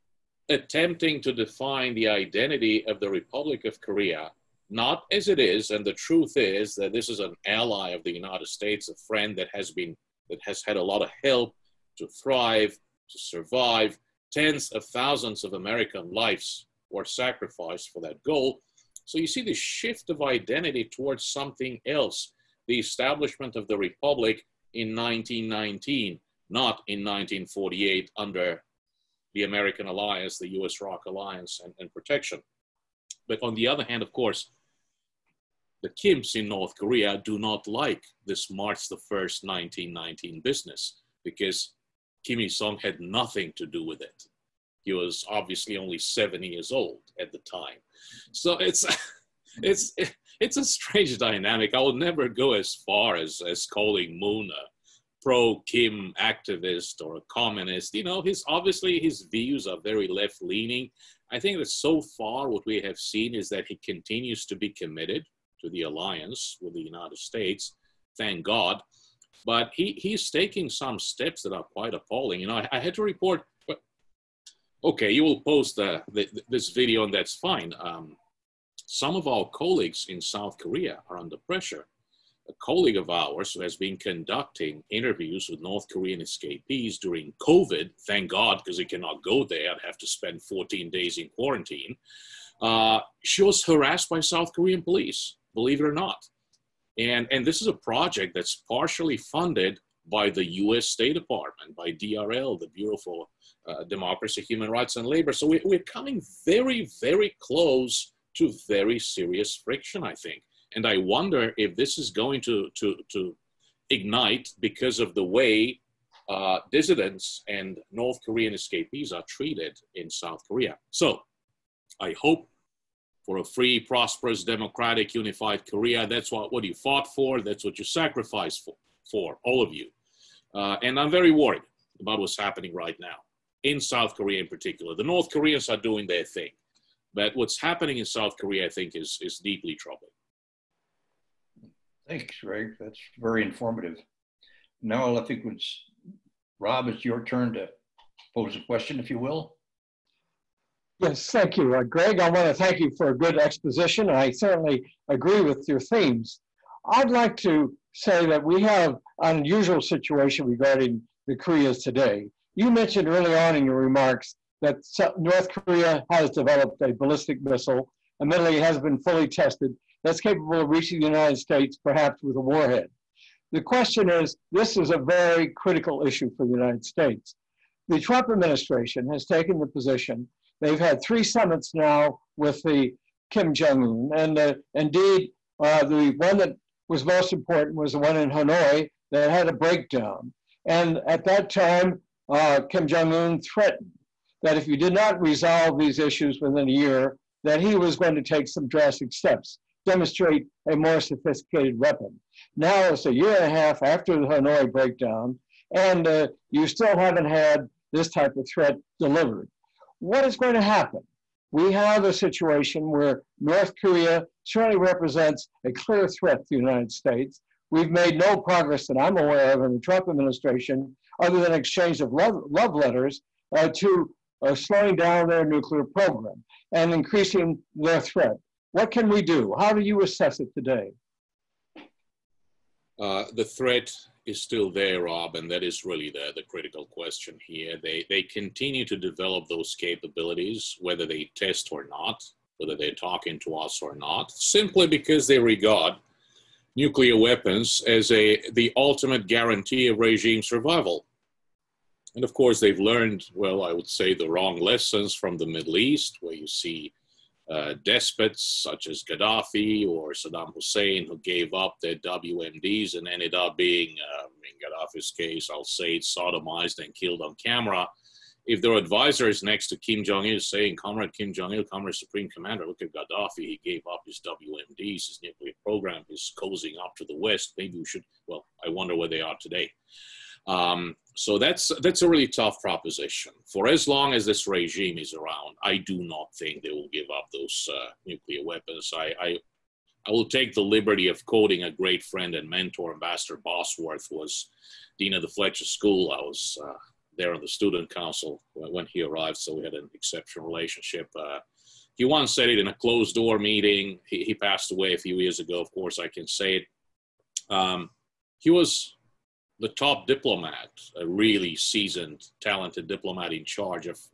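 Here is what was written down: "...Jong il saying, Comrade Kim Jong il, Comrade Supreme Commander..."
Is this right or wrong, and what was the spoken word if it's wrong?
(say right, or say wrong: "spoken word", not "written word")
right.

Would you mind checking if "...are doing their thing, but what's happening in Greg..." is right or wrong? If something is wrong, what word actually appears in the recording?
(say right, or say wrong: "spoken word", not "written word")
wrong: "South", not "Greg".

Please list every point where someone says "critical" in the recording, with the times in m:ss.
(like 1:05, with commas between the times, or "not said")
2:55, 3:56.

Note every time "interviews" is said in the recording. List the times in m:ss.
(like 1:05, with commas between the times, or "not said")
1:24.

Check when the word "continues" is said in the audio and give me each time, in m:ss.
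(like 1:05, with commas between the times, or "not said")
1:03, 3:58.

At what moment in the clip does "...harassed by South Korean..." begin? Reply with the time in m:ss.
1:33.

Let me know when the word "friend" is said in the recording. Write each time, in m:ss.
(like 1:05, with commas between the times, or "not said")
0:09, 4:52.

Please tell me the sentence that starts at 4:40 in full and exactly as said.
Um, so that's that's a really tough proposition.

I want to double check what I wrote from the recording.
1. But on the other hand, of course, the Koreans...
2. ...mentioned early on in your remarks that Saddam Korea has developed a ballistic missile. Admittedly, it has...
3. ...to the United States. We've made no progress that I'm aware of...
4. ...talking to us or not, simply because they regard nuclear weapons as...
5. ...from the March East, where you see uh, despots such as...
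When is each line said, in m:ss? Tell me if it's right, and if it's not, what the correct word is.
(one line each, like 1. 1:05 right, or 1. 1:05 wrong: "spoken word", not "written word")
1. 0:33 wrong: "Kims", not "Koreans"
2. 2:42 wrong: "North", not "Saddam"
3. 3:36 right
4. 4:02 right
5. 4:15 wrong: "Middle", not "March".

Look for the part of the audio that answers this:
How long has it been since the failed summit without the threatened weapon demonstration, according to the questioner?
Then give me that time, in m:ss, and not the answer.
3:23.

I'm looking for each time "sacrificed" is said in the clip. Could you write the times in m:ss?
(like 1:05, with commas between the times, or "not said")
0:17, 2:07.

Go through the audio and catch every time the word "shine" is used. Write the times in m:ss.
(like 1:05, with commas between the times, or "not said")
not said.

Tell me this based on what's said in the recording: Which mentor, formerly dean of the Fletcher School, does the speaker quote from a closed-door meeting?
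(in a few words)
Ambassador Bosworth.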